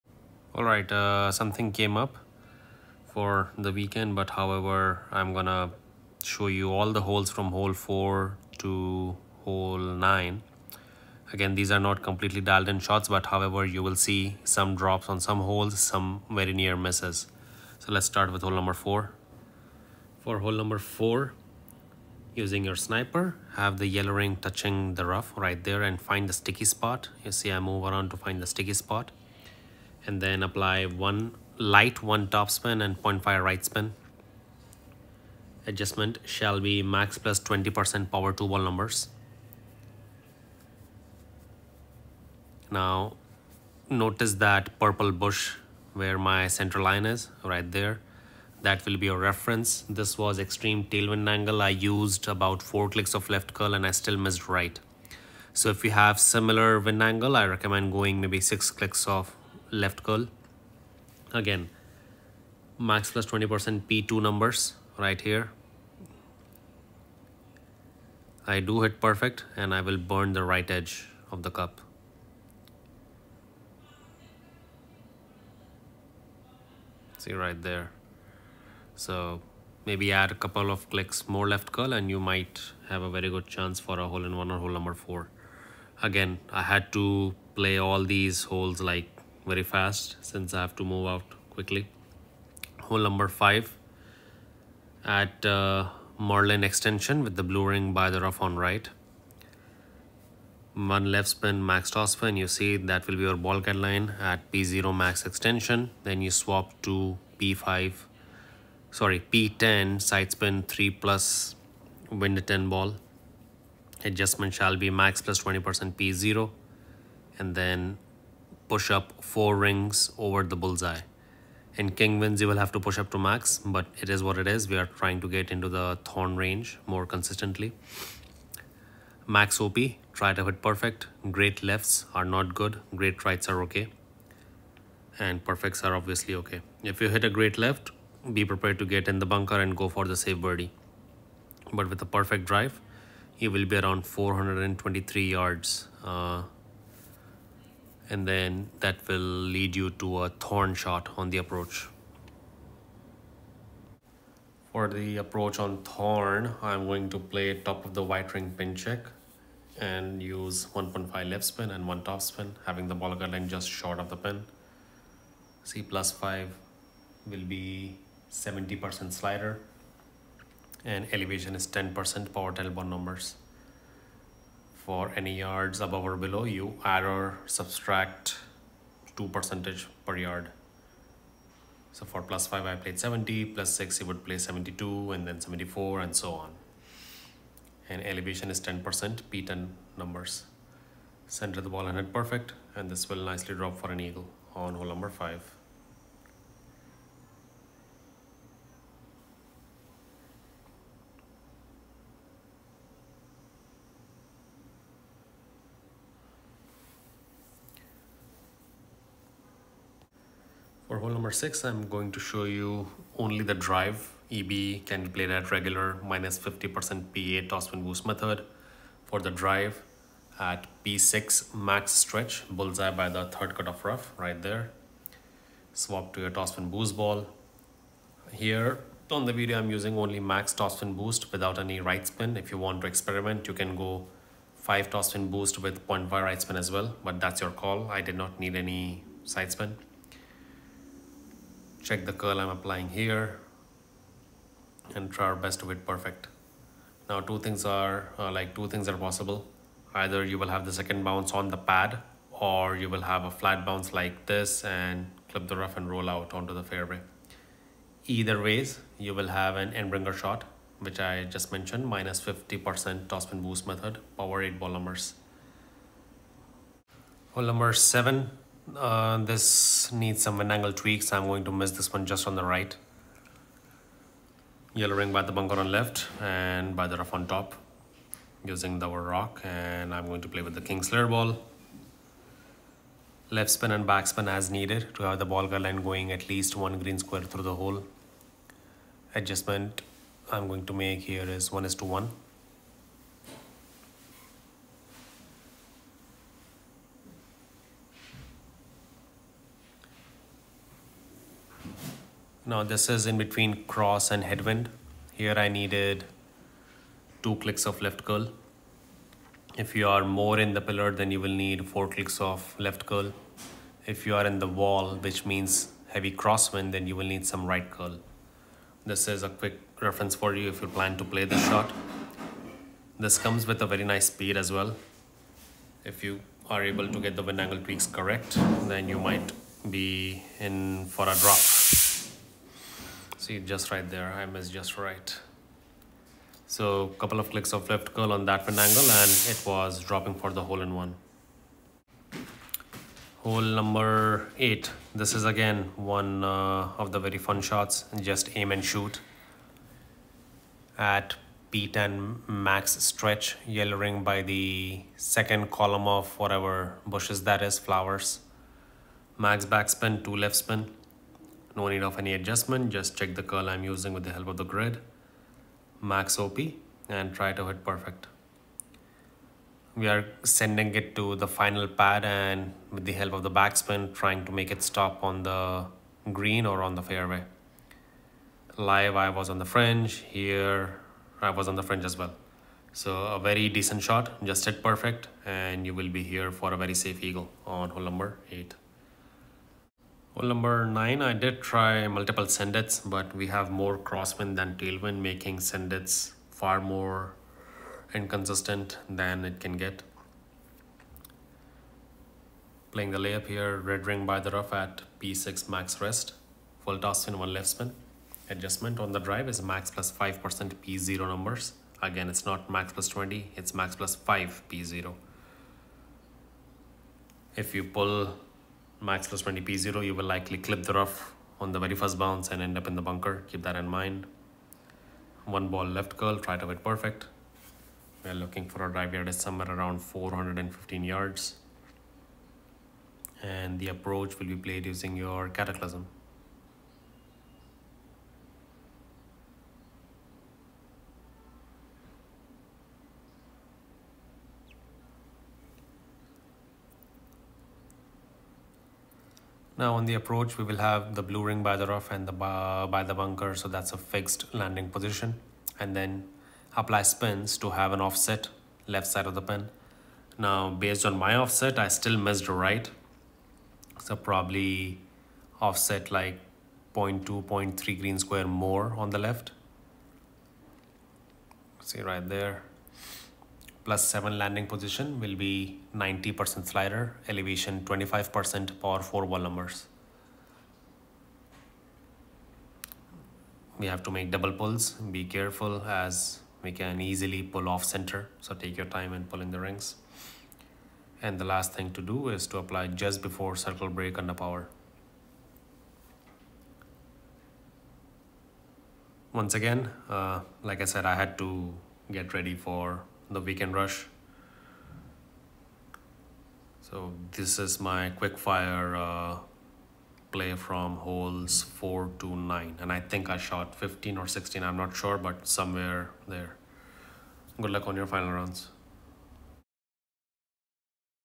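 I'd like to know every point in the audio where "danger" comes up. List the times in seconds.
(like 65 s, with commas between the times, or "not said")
not said.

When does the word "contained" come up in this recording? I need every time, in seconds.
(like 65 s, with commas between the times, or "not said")
not said.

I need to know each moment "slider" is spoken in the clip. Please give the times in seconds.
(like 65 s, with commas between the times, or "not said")
169 s, 476 s.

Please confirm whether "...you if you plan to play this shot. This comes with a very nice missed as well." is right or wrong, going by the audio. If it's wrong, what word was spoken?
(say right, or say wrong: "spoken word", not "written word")
wrong: "speed", not "missed".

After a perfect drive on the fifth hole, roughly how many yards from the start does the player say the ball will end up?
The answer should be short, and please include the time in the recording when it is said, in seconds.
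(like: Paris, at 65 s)
423 yards, at 144 s.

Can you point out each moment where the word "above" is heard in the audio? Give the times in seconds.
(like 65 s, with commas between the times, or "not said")
175 s.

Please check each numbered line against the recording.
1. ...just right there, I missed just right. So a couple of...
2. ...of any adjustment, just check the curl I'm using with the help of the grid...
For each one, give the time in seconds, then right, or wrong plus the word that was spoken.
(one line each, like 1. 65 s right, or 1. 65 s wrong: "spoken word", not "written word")
1. 333 s right
2. 361 s right.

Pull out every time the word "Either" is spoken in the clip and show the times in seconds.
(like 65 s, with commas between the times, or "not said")
249 s, 258 s.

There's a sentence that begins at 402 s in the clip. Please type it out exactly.
Playing the layup here, red ring by the rough at P6 max rest, full top spin, one left spin.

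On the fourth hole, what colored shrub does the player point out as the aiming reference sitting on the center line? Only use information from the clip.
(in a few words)
purple bush.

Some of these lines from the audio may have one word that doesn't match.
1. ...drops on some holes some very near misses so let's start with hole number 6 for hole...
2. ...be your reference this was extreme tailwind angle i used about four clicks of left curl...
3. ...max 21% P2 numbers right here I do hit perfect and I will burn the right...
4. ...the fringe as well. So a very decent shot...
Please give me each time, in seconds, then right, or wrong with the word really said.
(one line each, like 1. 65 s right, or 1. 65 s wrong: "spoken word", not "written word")
1. 14 s wrong: "4", not "6"
2. 48 s right
3. 62 s wrong: "20", not "21"
4. 381 s right.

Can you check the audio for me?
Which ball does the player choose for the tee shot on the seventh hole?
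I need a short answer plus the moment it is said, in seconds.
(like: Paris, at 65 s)
king slayer, at 280 s.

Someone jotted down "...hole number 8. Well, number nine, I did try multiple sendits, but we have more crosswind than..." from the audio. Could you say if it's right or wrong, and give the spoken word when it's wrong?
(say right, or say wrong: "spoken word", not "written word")
right.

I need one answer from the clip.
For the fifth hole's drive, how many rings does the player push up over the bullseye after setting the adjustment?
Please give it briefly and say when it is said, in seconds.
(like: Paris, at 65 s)
4, at 119 s.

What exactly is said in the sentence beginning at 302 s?
Now this is in between cross and headwind.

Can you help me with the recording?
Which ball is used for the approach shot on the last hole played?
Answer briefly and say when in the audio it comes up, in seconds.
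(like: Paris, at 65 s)
cataclysm, at 435 s.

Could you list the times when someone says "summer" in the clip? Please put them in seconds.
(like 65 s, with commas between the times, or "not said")
not said.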